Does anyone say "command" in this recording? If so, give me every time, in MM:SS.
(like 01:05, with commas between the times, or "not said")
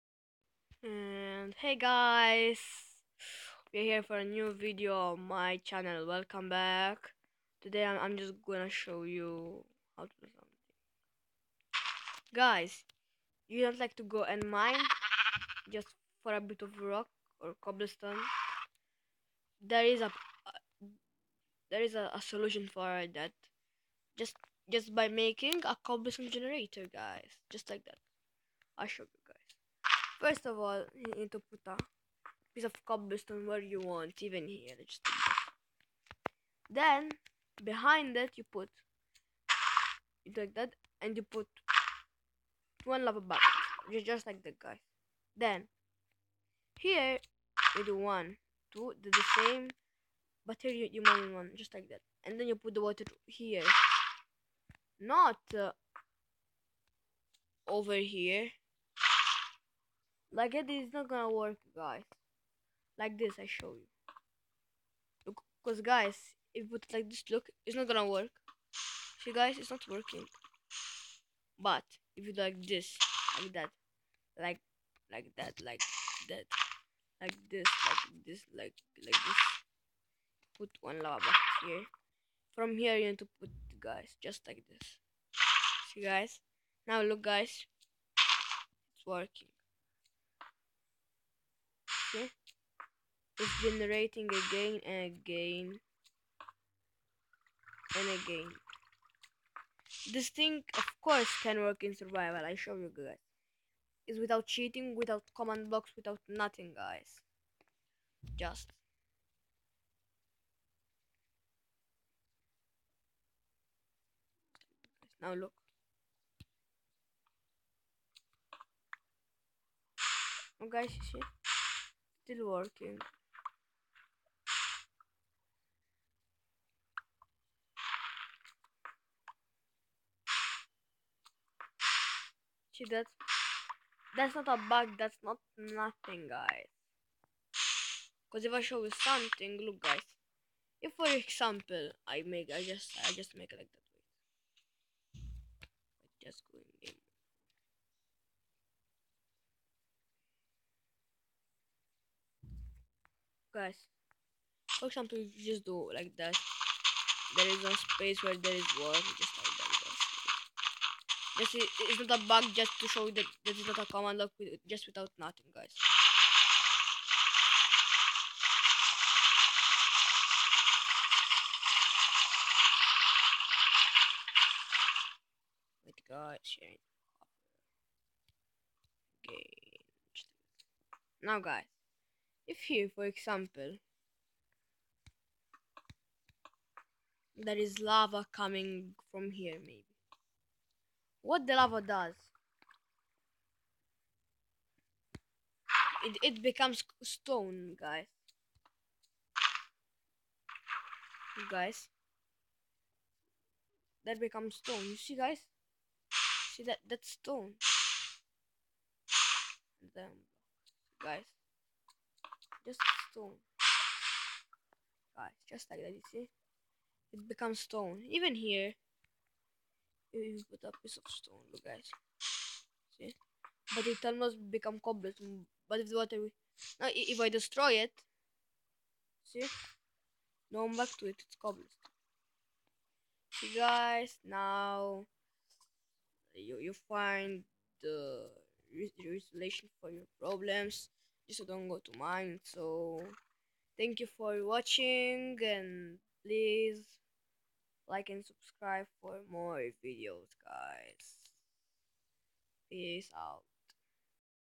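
01:45, 02:43.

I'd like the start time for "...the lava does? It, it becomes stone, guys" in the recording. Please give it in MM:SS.
03:11.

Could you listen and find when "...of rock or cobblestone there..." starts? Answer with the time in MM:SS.
00:16.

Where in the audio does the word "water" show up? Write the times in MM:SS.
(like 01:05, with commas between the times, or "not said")
00:52, 02:38, 03:45.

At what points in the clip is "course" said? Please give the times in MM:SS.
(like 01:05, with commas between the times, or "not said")
01:41.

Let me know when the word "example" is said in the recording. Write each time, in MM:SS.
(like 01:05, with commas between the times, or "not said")
02:21, 02:34, 03:03.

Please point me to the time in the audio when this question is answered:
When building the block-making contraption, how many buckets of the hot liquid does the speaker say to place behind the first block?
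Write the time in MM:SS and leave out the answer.
00:42.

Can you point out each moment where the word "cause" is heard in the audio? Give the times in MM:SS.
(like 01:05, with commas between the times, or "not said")
01:05, 02:18.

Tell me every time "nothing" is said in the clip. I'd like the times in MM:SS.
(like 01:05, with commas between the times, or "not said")
01:46, 02:15, 02:45.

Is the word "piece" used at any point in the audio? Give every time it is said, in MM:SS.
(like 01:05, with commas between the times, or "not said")
00:32, 03:40.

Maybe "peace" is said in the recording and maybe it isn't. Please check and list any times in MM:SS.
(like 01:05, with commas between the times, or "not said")
04:12.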